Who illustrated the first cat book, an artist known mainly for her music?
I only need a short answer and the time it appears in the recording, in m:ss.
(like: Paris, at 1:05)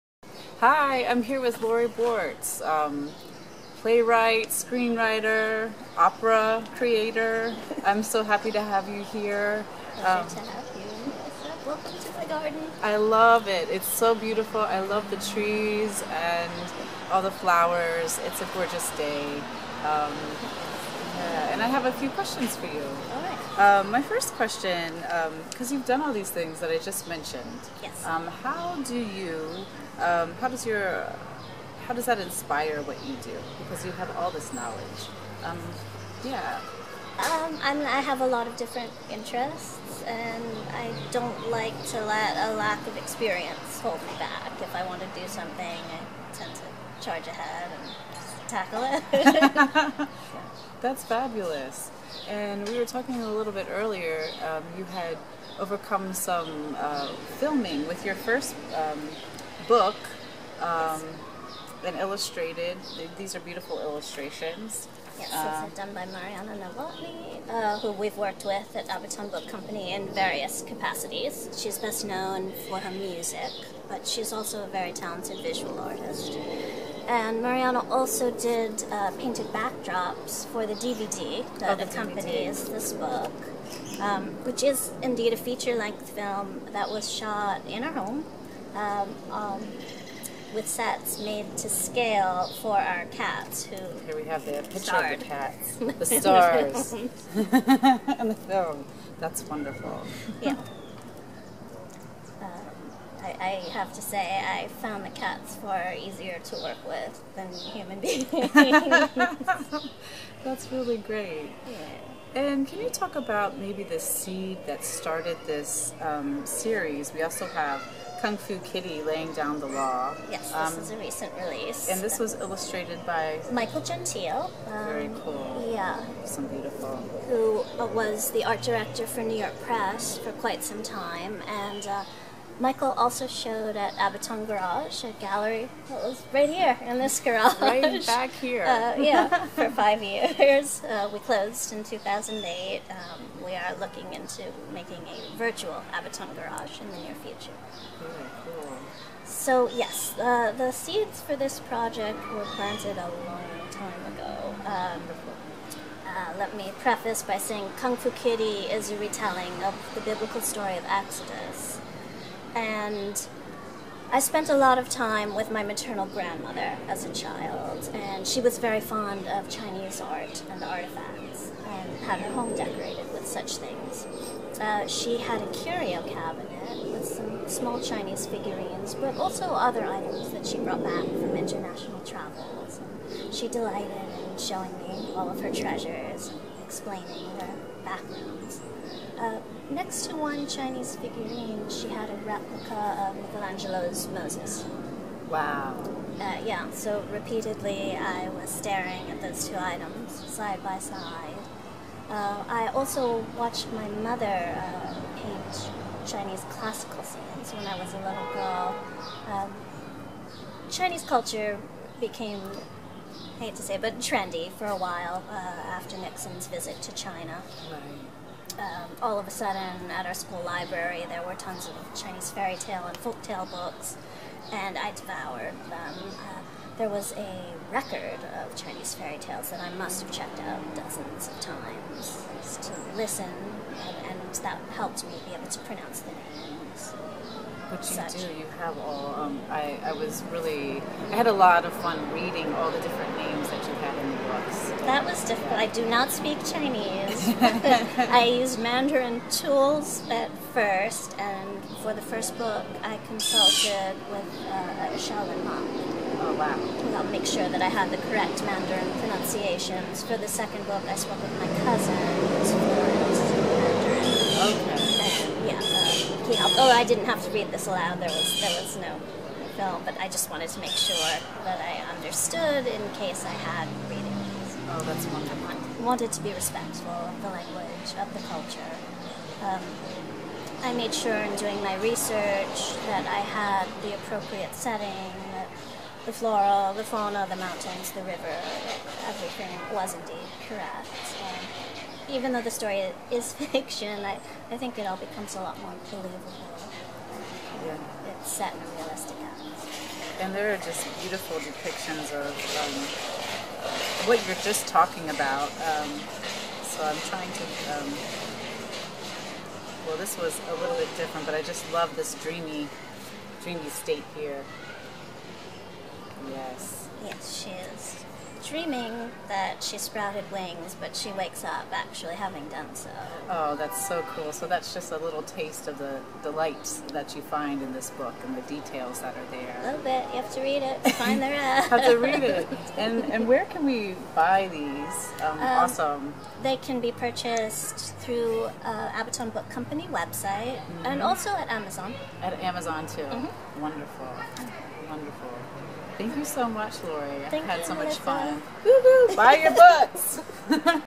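Marianne Nowottny, at 1:06.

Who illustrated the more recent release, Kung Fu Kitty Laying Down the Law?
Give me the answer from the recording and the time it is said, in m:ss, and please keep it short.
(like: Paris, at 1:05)
Michael Gentile, at 2:03.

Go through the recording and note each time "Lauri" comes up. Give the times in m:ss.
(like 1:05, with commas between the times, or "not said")
0:01, 5:46.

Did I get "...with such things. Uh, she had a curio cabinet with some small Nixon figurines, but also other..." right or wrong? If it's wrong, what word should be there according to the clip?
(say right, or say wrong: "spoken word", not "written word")
wrong: "Chinese", not "Nixon".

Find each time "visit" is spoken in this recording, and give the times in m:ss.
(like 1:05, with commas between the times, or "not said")
3:36.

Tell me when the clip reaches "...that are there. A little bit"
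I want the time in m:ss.
5:29.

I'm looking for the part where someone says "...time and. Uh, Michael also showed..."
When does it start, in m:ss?
2:10.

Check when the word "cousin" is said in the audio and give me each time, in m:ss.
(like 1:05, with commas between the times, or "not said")
4:21.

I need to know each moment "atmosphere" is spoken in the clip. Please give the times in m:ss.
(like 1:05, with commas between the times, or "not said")
4:59.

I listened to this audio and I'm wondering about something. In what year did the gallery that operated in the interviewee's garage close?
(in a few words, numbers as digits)
2008.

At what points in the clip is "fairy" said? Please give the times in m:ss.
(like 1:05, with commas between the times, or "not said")
3:42, 3:48.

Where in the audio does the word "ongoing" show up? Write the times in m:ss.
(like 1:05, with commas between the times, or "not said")
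not said.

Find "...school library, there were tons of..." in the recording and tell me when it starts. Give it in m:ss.
3:40.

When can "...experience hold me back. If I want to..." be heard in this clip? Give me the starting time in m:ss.
0:42.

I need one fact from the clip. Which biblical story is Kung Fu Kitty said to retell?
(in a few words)
Exodus.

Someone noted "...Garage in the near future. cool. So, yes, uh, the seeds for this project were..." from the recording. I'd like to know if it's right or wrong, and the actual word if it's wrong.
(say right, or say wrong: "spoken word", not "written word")
right.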